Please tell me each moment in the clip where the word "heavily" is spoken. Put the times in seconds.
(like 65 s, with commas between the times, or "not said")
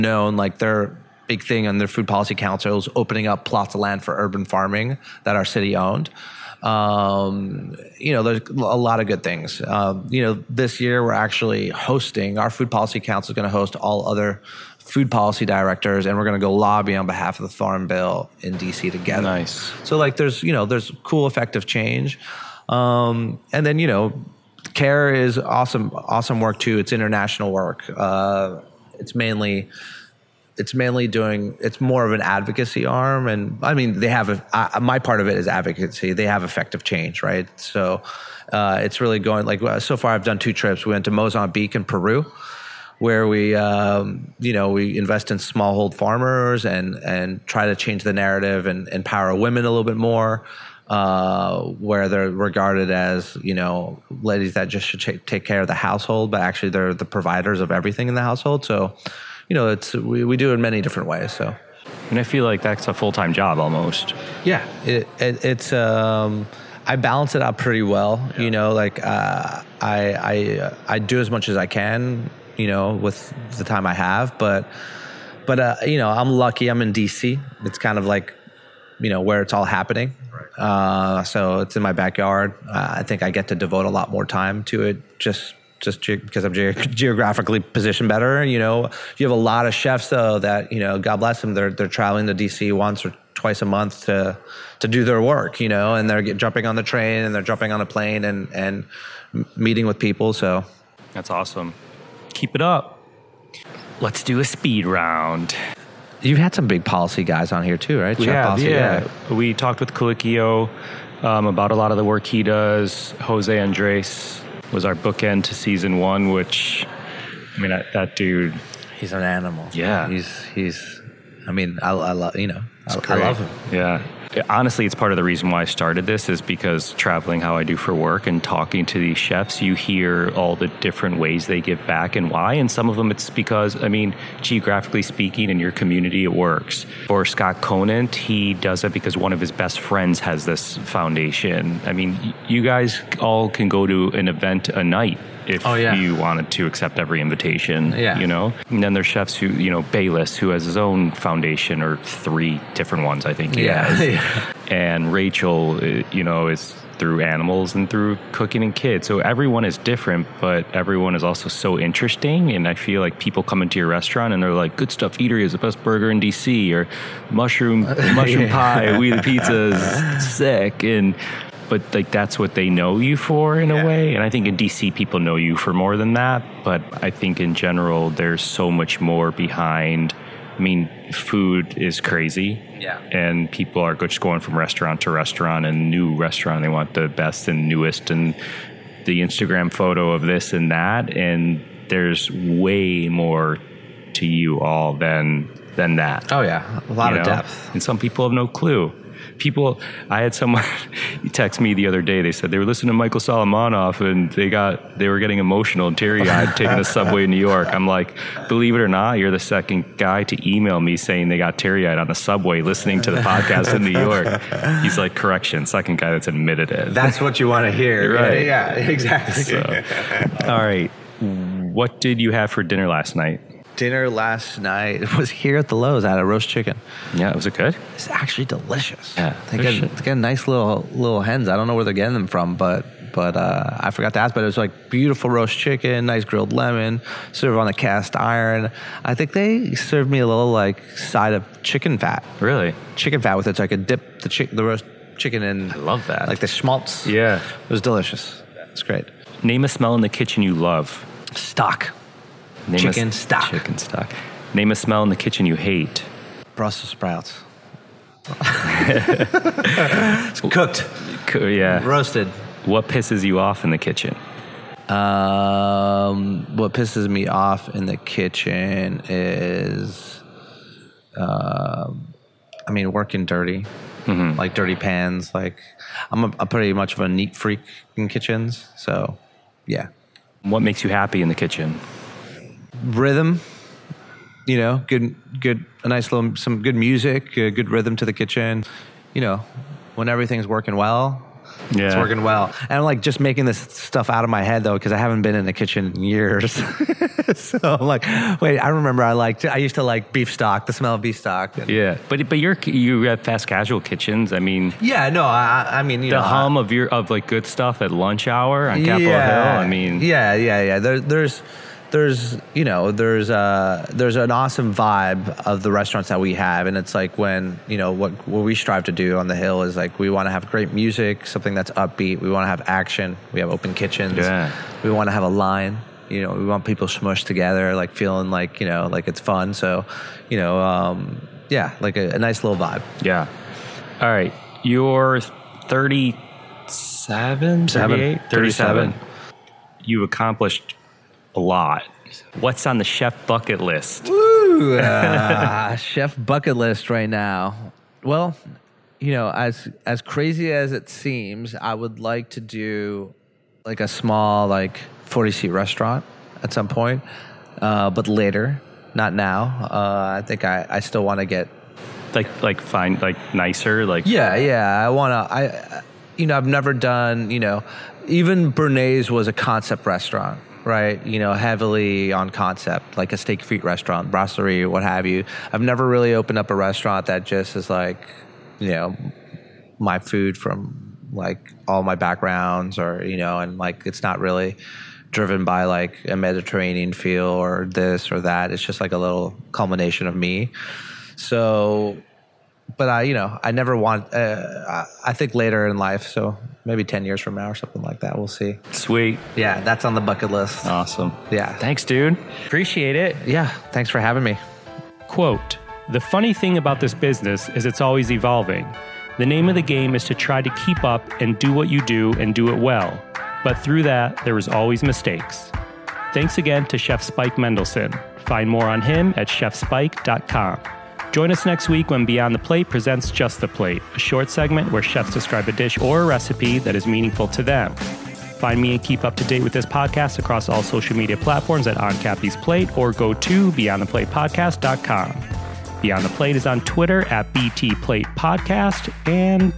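371 s.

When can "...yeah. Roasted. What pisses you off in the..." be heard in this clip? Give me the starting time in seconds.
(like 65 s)
261 s.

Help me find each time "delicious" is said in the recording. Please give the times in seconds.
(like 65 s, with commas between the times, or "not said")
228 s, 247 s.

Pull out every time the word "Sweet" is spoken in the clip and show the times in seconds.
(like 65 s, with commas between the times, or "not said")
398 s.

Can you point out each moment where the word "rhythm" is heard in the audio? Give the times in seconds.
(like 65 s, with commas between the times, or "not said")
282 s, 287 s.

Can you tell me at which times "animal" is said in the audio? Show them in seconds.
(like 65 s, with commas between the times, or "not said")
119 s, 157 s.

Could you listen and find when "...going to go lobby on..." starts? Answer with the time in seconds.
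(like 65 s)
16 s.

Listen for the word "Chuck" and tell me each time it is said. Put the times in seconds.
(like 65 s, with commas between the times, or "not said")
108 s.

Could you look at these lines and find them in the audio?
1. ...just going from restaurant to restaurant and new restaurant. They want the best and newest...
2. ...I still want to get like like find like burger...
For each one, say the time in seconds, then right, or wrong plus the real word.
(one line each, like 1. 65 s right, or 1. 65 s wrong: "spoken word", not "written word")
1. 183 s right
2. 360 s wrong: "nicer", not "burger".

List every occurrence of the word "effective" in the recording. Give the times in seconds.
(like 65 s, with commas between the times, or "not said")
21 s, 36 s.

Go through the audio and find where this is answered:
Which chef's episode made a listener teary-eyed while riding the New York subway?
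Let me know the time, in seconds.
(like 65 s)
202 s.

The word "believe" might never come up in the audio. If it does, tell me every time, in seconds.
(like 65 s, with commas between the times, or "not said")
208 s.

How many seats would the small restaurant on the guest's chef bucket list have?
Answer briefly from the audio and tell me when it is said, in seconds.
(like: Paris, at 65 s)
40, at 355 s.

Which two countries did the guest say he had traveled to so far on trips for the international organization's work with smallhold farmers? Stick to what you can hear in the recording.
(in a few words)
Mozambique and Peru.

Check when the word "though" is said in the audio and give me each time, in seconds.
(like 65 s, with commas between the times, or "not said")
90 s, 294 s.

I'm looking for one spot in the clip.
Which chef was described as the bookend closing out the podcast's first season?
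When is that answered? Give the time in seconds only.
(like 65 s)
113 s.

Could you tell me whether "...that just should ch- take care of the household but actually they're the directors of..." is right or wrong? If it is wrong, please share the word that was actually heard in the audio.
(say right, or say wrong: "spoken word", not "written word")
wrong: "providers", not "directors".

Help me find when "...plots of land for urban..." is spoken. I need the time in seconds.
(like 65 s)
3 s.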